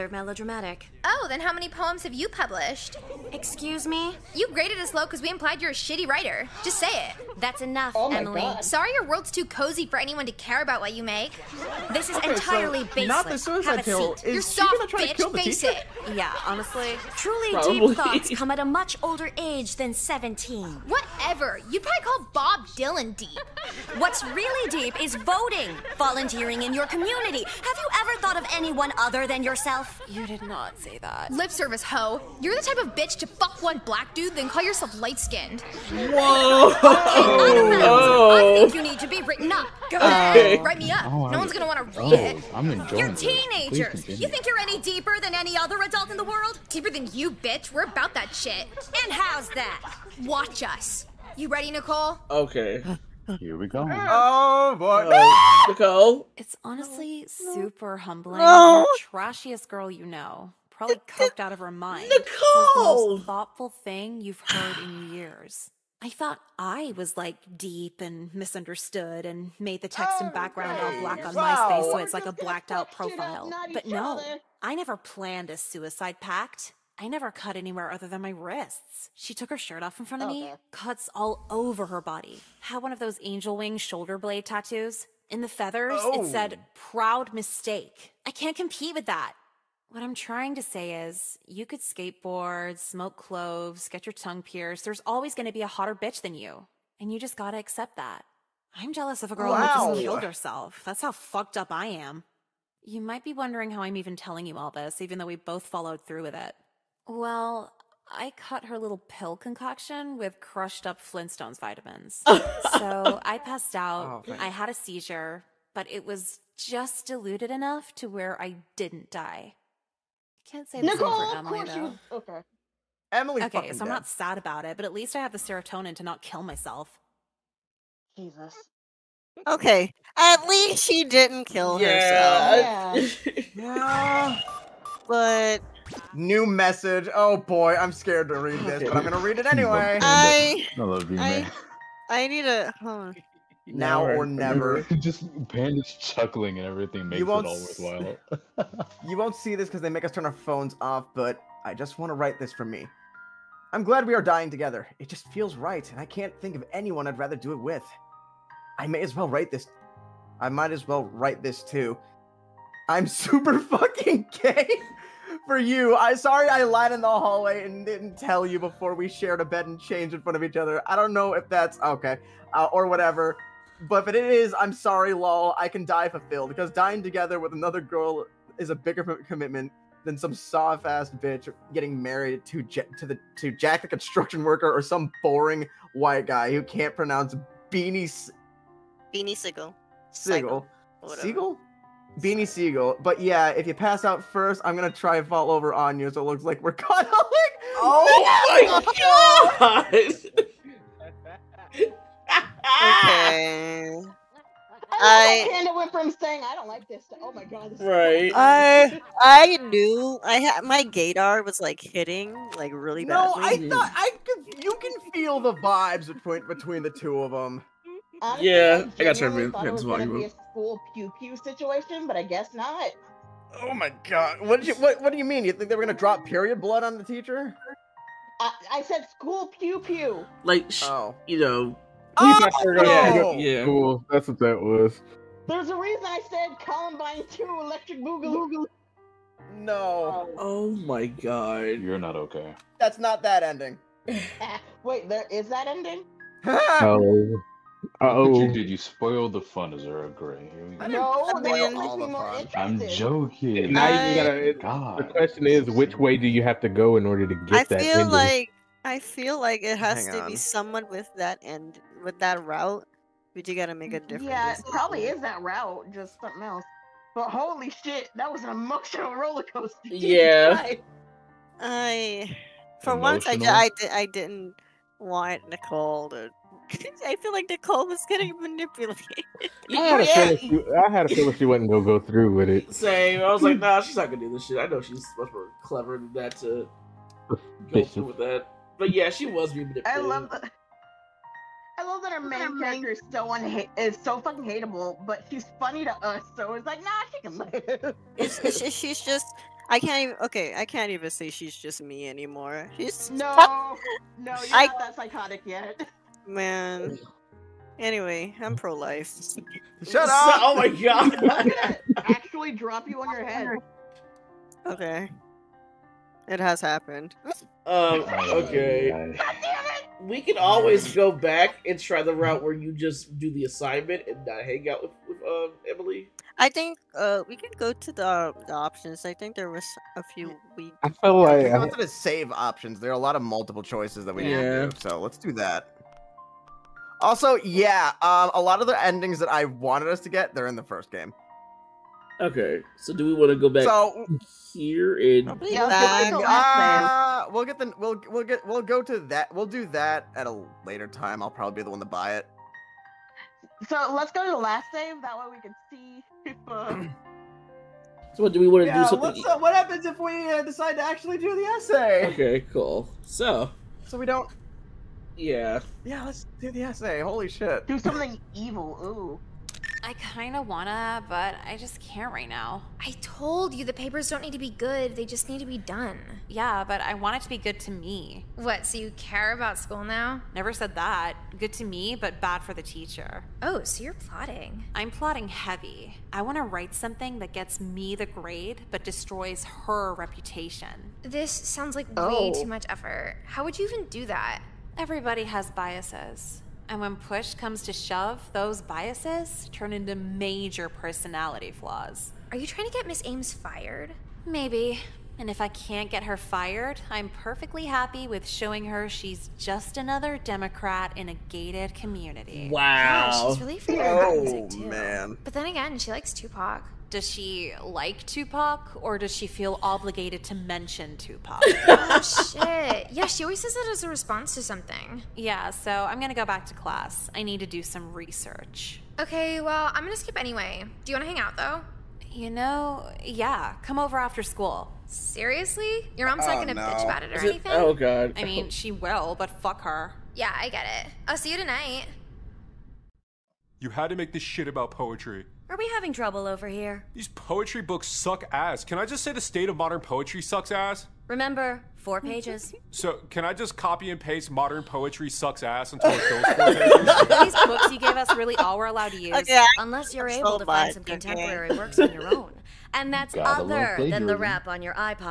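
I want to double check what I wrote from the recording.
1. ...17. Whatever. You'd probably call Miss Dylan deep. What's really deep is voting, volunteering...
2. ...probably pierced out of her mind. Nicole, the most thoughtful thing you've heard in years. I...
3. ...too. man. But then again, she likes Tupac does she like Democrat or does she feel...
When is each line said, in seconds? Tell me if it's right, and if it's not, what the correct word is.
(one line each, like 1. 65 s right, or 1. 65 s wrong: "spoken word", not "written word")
1. 19 s wrong: "Bob", not "Miss"
2. 60 s wrong: "coked", not "pierced"
3. 414 s wrong: "Tupac", not "Democrat".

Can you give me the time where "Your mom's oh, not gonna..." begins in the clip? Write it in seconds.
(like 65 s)
435 s.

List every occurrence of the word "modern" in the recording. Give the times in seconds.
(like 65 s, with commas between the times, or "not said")
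449 s, 454 s.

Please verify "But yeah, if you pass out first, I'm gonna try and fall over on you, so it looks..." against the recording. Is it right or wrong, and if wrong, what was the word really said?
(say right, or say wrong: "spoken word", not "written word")
right.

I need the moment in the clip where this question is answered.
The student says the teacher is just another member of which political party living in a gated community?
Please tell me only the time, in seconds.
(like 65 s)
410 s.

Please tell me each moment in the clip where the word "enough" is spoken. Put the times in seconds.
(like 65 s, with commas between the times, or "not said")
7 s, 117 s.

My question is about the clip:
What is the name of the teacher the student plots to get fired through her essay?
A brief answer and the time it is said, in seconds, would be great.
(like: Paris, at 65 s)
Miss Ames, at 402 s.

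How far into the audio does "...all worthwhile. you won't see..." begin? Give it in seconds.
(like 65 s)
147 s.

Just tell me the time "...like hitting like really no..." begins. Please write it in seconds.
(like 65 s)
211 s.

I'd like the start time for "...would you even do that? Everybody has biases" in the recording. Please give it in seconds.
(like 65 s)
393 s.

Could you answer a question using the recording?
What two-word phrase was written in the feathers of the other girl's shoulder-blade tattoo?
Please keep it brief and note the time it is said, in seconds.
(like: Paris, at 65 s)
Proud mistake, at 86 s.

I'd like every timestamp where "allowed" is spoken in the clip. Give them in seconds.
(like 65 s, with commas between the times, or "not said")
458 s.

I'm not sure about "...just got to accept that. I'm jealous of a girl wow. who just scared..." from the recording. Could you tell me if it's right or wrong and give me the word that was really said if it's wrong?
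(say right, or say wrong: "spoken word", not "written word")
wrong: "killed", not "scared".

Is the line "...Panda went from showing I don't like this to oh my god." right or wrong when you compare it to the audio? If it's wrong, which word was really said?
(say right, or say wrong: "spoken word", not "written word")
wrong: "saying", not "showing".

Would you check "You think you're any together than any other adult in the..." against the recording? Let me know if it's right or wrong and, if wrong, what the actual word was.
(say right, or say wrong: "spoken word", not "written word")
wrong: "deeper", not "together".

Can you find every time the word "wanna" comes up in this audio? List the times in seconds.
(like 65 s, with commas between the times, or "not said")
370 s, 386 s, 430 s.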